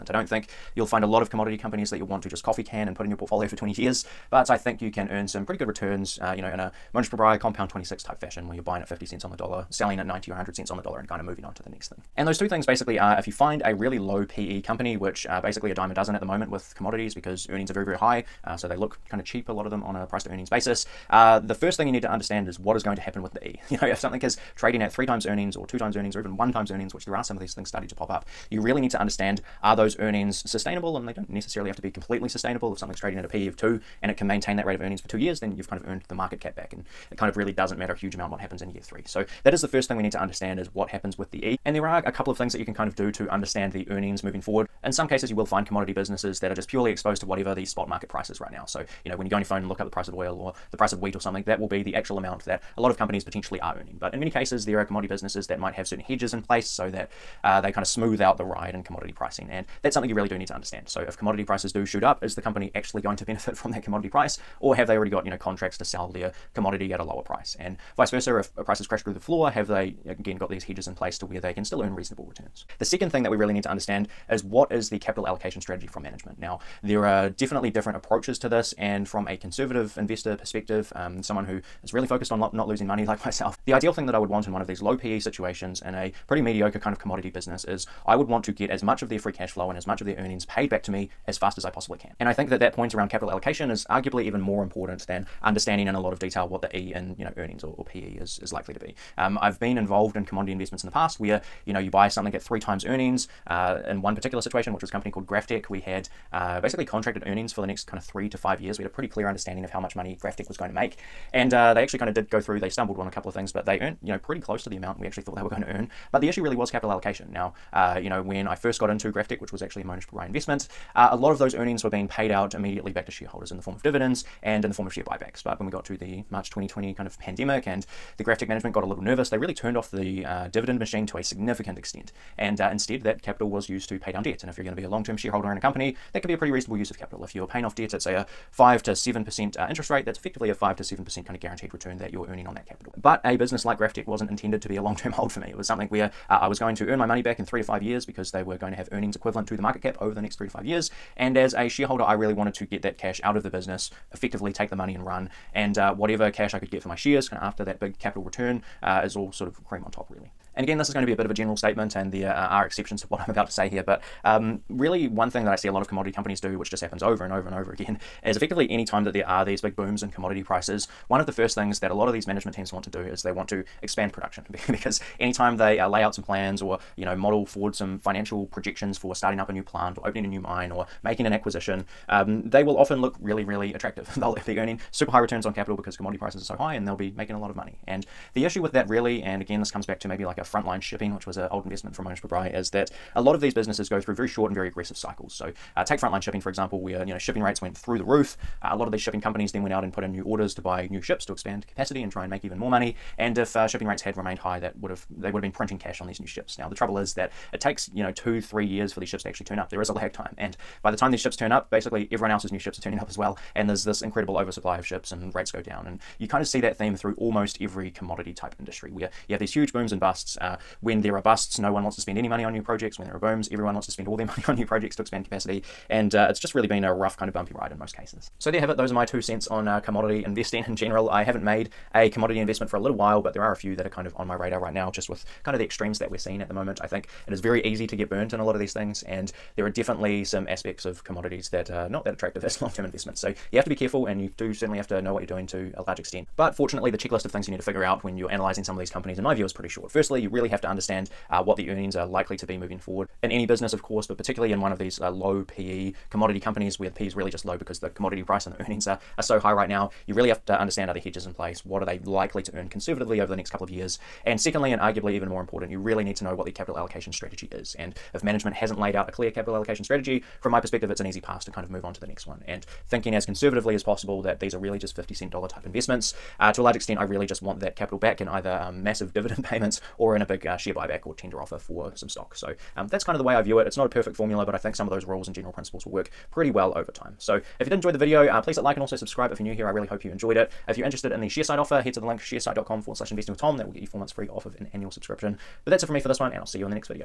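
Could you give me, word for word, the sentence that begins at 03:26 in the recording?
Now the trouble is that it takes you know two three years for these ships to actually turn up.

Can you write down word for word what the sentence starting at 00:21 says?
Uh, the first thing you need to understand is what is going to happen with the E.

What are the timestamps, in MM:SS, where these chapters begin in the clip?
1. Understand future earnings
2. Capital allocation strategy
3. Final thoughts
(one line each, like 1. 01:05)
1. 00:12
2. 01:12
3. 03:48.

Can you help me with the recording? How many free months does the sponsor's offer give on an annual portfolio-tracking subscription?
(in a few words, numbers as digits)
4 months.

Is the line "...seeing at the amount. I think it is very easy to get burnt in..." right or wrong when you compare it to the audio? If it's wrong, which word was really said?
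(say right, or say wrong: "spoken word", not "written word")
wrong: "moment", not "amount".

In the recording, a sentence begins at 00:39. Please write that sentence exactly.
So that is the first thing we need to understand is what happens with the E.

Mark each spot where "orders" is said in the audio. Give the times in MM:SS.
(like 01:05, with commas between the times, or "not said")
03:20.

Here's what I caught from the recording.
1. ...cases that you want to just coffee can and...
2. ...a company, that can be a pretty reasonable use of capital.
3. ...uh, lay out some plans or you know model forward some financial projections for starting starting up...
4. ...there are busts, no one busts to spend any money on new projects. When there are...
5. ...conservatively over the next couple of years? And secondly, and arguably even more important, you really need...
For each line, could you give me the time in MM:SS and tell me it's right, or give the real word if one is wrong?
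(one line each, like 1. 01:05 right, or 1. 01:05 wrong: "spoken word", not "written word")
1. 00:01 wrong: "companies", not "cases"
2. 02:15 right
3. 02:55 right
4. 03:41 wrong: "wants", not "busts"
5. 04:22 right.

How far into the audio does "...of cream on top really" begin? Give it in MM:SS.
02:39.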